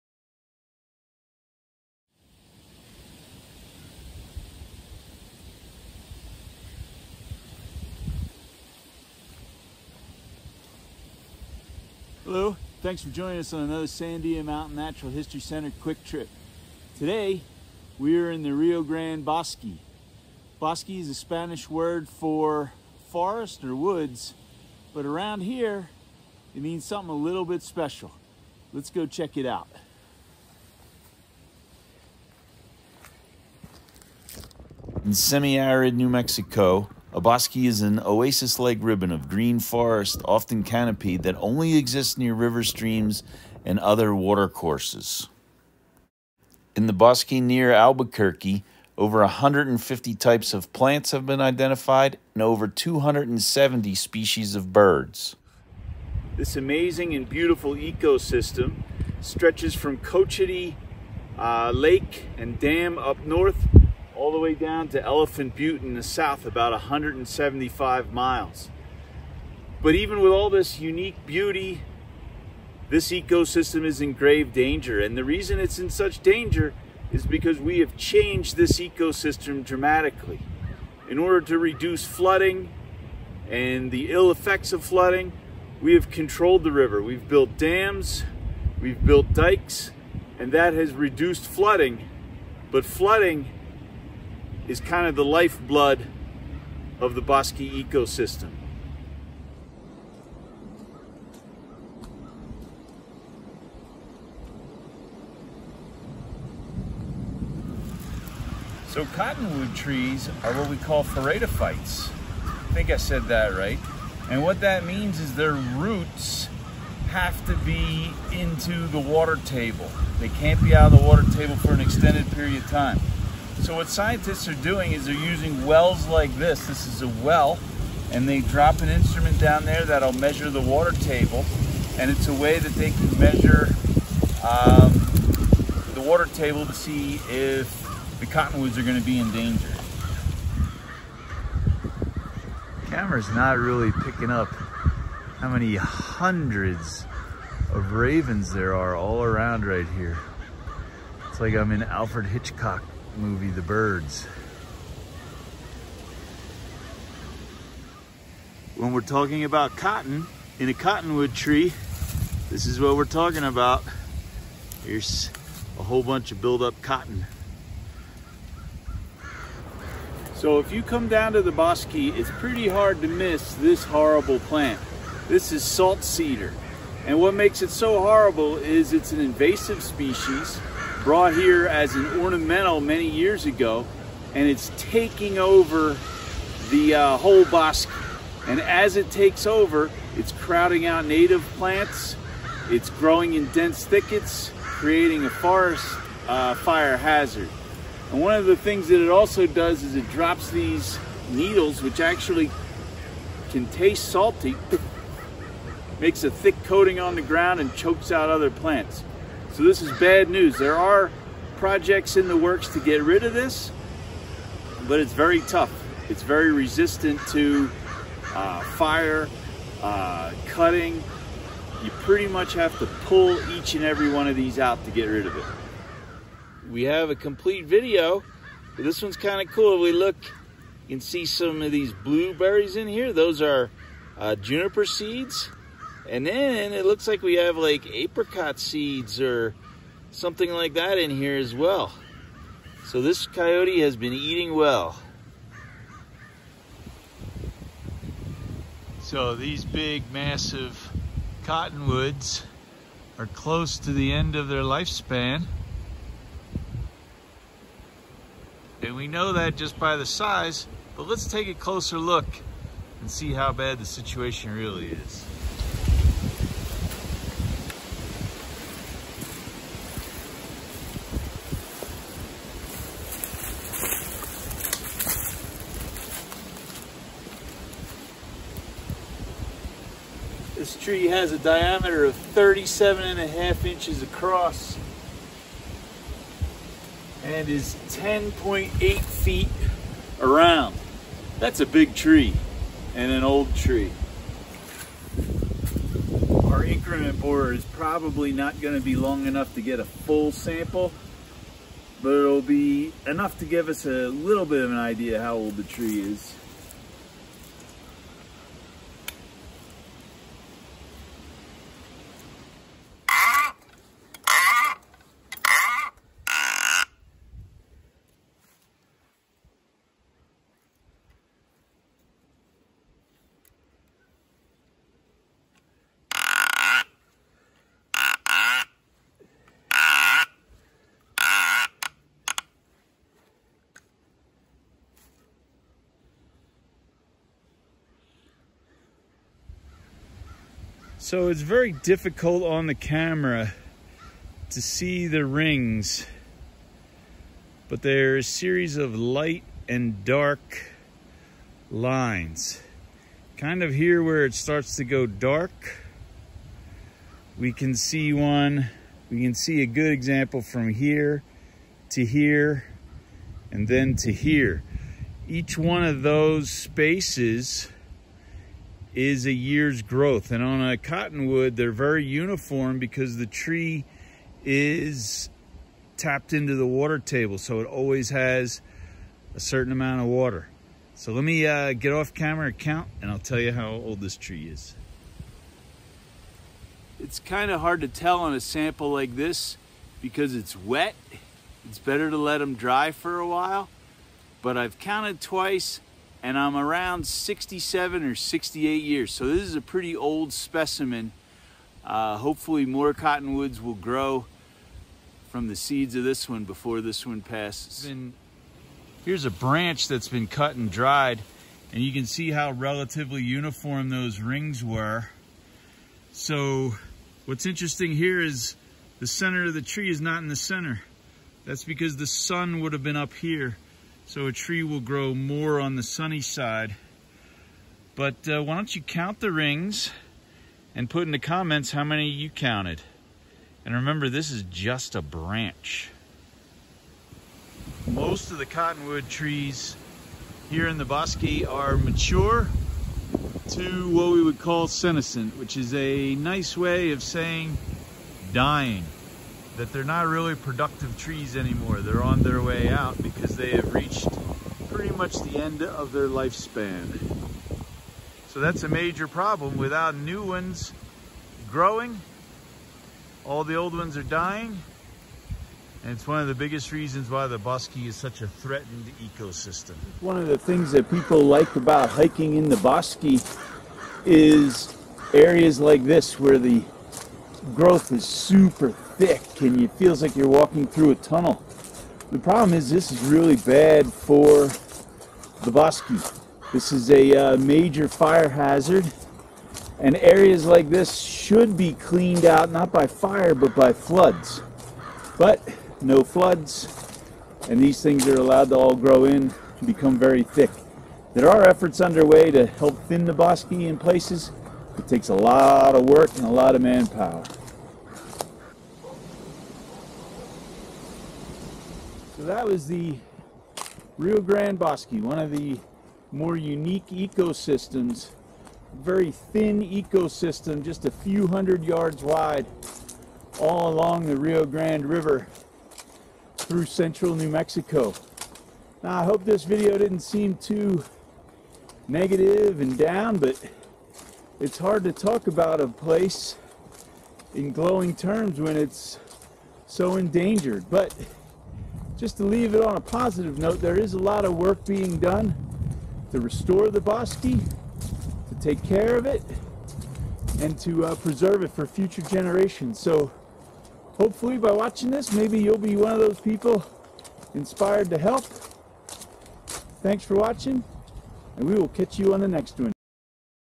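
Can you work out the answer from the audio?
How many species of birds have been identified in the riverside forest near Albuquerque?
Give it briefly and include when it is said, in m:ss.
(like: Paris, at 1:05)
over 270, at 0:52.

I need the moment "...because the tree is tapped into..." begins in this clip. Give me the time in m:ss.
6:12.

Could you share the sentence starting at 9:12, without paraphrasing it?
So hopefully by watching this, maybe you'll be one of those people inspired to help.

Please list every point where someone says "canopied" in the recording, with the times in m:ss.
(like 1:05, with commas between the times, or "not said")
0:40.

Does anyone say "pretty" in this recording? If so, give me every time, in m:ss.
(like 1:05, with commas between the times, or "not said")
2:52, 3:42, 6:39, 7:34.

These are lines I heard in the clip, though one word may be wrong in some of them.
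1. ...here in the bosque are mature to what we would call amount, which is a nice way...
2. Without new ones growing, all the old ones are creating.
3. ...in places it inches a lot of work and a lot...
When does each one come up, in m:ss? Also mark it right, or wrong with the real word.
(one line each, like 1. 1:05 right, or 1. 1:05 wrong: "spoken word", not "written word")
1. 7:20 wrong: "senescent", not "amount"
2. 7:39 wrong: "dying", not "creating"
3. 8:23 wrong: "takes", not "inches".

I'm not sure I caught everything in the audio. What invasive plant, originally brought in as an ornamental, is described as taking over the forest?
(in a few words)
salt cedar.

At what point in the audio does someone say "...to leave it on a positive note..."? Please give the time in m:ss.
9:02.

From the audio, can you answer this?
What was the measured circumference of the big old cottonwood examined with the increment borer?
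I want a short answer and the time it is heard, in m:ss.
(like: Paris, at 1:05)
10.8 feet, at 4:47.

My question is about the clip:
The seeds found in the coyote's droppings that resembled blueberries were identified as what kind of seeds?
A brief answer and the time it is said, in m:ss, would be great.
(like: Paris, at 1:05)
juniper, at 3:54.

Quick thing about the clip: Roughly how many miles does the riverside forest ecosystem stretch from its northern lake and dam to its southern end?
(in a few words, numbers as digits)
175 miles.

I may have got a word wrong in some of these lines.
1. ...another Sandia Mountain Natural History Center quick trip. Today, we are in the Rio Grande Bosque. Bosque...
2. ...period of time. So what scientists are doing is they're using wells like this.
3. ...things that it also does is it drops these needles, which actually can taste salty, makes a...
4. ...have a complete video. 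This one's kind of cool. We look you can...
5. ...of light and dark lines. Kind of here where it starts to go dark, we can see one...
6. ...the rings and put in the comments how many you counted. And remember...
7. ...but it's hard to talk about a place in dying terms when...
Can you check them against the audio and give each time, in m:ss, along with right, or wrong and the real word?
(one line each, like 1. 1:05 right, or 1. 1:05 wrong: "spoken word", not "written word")
1. 0:13 right
2. 2:02 right
3. 3:18 right
4. 3:46 right
5. 5:48 right
6. 7:09 right
7. 8:53 wrong: "glowing", not "dying".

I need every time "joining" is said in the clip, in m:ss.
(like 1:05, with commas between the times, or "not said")
0:13.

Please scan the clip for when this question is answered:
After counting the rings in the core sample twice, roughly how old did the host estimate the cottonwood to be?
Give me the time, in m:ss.
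6:37.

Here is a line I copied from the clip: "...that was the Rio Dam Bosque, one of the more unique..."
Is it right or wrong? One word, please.
wrong.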